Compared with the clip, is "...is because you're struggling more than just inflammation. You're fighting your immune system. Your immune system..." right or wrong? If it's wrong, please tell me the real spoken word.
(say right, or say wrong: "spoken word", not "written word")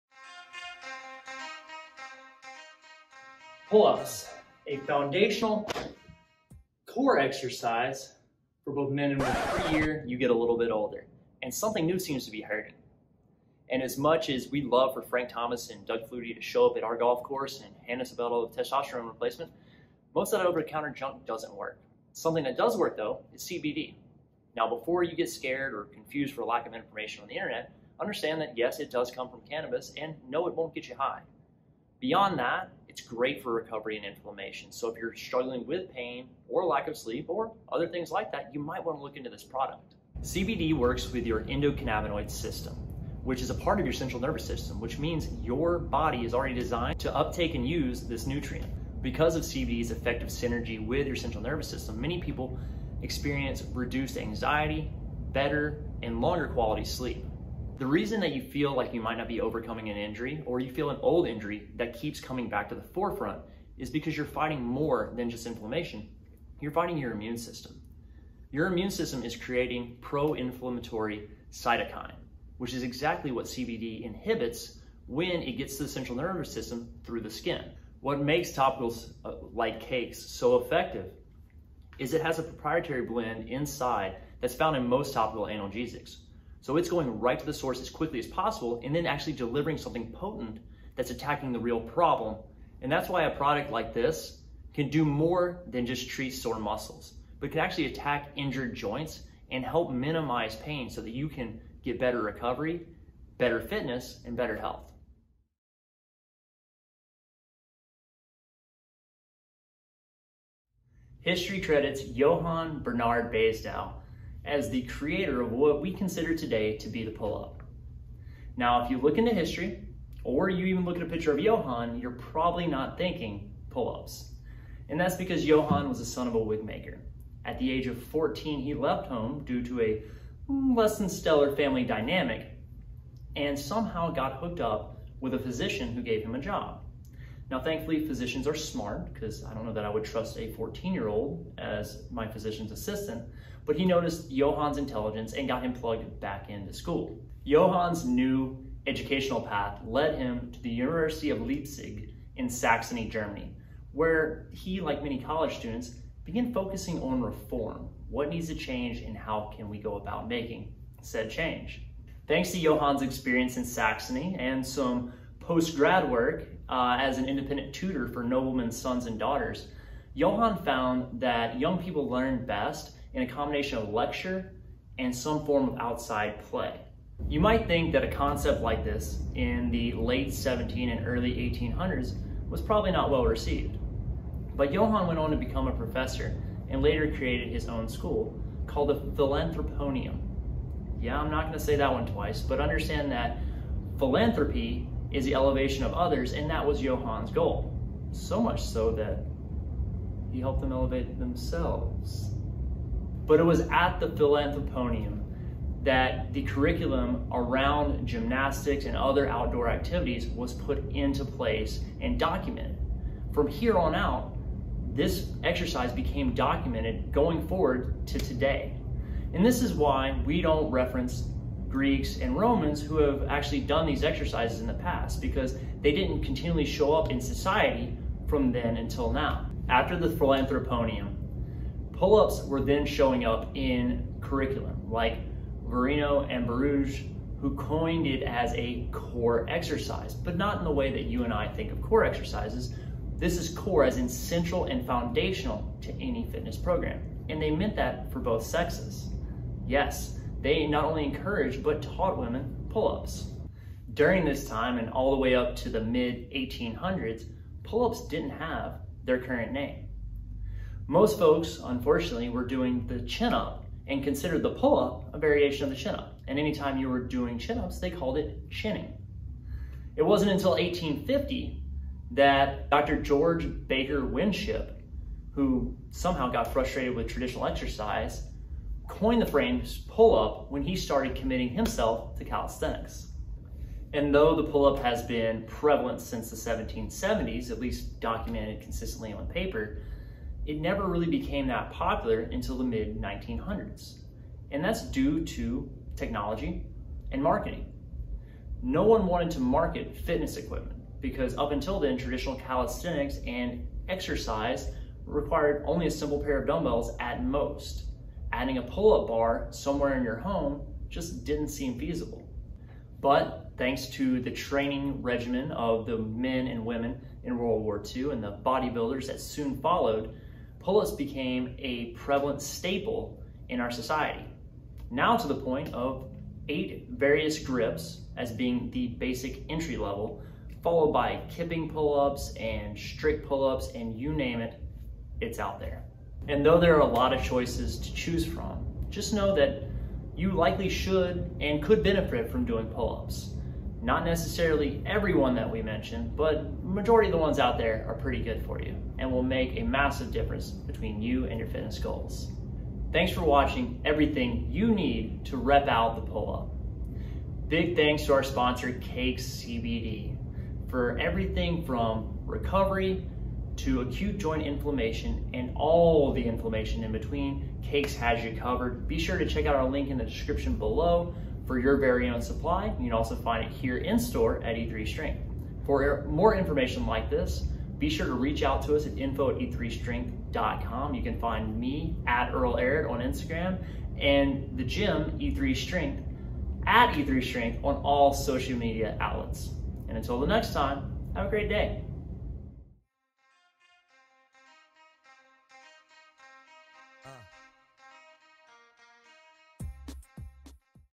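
wrong: "fighting", not "struggling".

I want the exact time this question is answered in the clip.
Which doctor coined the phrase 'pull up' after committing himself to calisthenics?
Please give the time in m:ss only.
4:33.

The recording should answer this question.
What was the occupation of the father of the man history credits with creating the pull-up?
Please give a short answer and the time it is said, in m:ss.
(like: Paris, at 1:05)
Wig maker, at 2:06.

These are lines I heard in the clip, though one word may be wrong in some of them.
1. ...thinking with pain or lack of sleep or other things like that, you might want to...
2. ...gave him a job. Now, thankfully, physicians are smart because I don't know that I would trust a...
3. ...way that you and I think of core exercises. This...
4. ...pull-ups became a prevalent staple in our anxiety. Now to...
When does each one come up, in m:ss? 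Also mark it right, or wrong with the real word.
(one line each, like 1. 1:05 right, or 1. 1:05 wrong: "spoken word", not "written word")
1. 0:35 wrong: "struggling", not "thinking"
2. 2:16 right
3. 4:00 right
4. 5:20 wrong: "society", not "anxiety".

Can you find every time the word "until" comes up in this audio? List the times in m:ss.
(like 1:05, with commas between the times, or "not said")
3:48, 4:30, 4:52, 5:01, 6:29.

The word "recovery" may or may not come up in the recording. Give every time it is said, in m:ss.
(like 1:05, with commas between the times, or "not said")
0:33, 1:42, 6:02.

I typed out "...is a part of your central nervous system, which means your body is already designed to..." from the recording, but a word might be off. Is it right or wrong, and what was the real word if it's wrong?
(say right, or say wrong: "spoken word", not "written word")
right.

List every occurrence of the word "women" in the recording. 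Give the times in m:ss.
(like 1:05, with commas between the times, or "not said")
0:09, 4:12, 5:16.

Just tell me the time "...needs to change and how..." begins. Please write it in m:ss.
2:38.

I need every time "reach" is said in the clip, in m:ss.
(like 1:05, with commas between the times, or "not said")
6:18.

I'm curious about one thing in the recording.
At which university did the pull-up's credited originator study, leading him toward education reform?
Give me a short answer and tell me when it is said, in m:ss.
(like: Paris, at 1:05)
University of Leipzig, at 2:30.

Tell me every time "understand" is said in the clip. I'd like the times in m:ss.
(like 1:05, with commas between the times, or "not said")
0:28, 3:12.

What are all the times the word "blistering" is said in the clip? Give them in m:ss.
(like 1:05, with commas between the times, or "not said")
not said.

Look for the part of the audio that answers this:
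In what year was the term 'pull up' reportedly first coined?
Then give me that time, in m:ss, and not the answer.
4:30.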